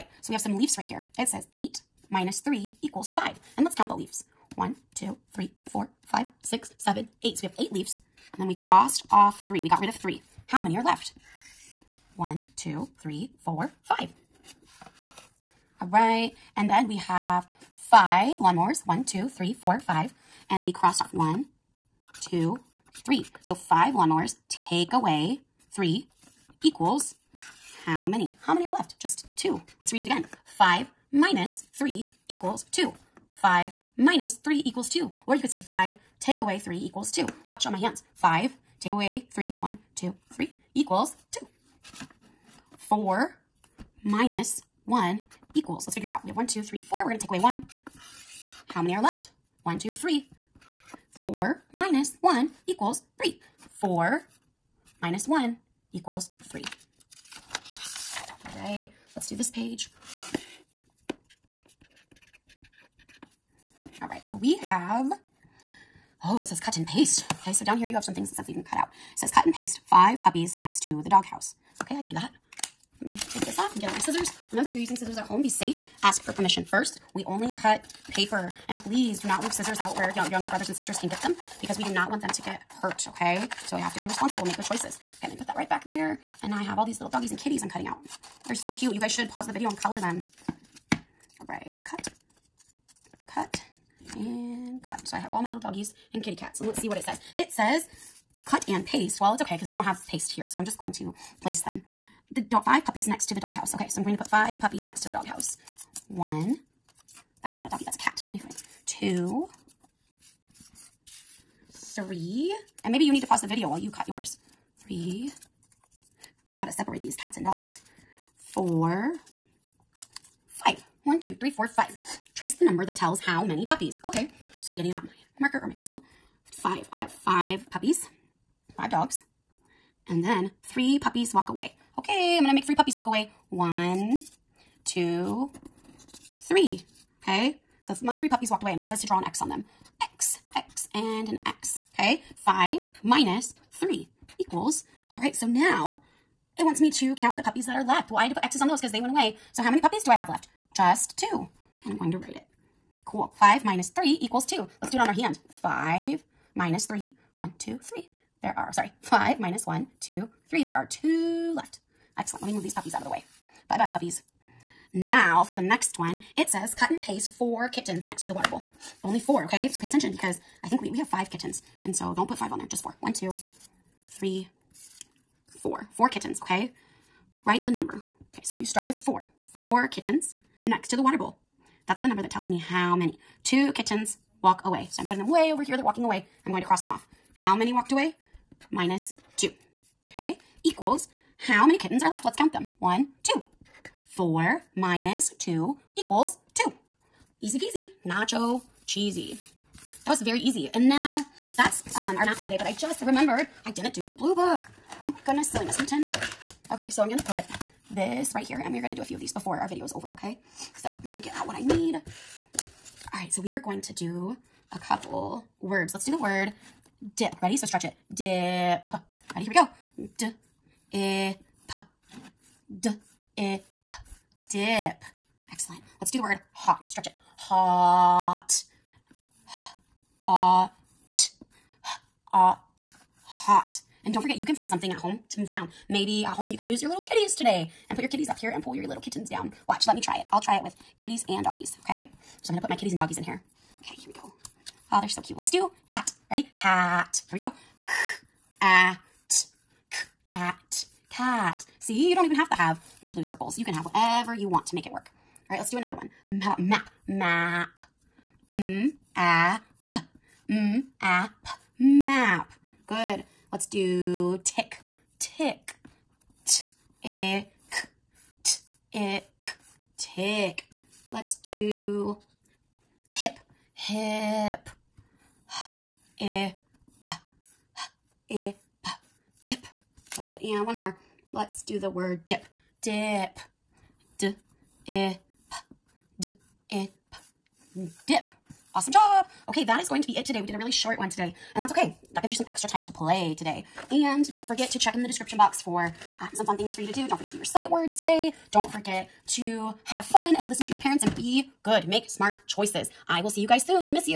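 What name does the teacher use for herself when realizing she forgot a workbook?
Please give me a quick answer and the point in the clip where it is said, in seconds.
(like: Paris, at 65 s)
Miss Newton, at 205 s.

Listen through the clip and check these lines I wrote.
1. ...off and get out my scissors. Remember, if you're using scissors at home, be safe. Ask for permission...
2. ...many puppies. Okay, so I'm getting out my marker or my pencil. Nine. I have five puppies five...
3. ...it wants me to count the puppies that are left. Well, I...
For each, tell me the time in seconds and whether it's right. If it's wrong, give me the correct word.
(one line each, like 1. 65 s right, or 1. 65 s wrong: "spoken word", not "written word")
1. 73 s right
2. 123 s wrong: "Five", not "Nine"
3. 146 s right.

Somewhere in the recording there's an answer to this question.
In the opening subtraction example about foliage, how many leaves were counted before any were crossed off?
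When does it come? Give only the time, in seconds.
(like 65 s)
7 s.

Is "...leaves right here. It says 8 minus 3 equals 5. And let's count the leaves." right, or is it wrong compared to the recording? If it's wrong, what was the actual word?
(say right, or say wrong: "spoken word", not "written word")
right.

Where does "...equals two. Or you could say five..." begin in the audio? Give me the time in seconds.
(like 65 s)
34 s.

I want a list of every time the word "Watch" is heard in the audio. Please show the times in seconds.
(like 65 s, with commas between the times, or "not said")
37 s, 239 s.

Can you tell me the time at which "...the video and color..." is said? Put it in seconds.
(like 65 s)
89 s.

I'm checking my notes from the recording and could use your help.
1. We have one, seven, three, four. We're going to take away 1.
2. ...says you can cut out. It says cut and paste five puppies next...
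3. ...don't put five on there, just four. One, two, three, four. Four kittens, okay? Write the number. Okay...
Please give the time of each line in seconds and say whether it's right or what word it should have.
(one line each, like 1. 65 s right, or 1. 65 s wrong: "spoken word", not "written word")
1. 46 s wrong: "two", not "seven"
2. 68 s right
3. 172 s right.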